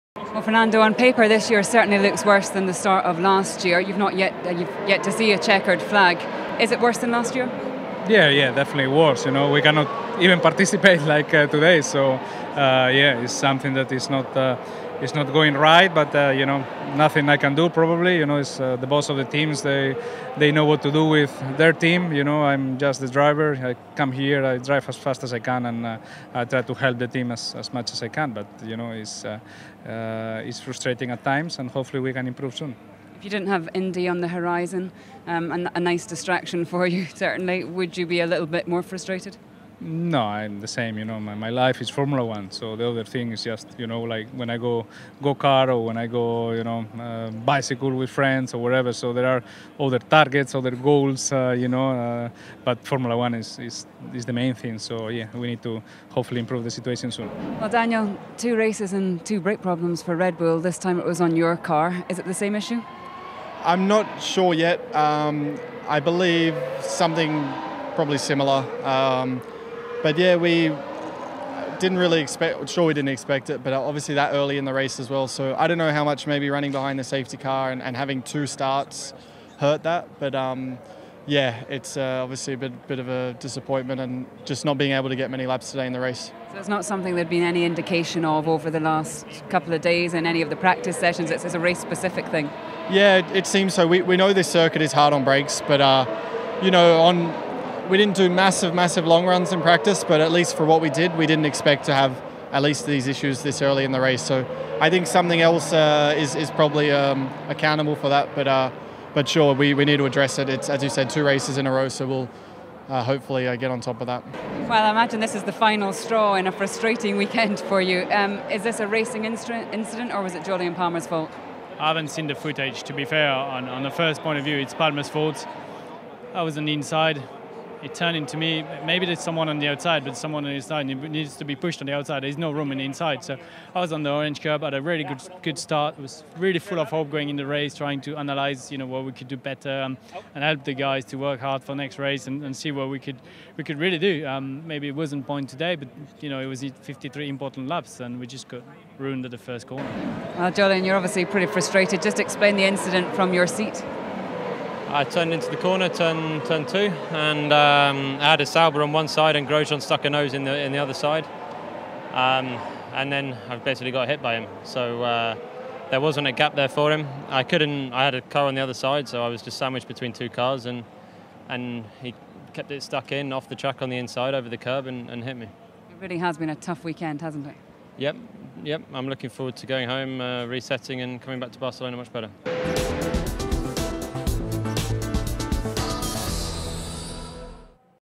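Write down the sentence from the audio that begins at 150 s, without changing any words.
Well, Jolyon, you're obviously pretty frustrated.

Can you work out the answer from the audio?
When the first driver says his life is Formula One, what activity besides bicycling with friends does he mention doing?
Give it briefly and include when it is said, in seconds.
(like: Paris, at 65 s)
go kart, at 45 s.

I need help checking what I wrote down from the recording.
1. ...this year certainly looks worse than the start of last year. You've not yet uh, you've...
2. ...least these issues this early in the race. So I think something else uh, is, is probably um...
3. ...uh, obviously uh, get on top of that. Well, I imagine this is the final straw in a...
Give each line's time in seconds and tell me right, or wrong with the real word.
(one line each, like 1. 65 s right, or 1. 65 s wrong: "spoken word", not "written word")
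1. 1 s right
2. 102 s right
3. 112 s wrong: "hopefully", not "obviously".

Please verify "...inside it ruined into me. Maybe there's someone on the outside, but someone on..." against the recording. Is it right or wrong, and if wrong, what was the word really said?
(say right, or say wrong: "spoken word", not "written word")
wrong: "turned", not "ruined".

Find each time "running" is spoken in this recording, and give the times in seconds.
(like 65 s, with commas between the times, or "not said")
76 s.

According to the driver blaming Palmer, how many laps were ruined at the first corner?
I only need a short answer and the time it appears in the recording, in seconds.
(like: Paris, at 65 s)
53, at 146 s.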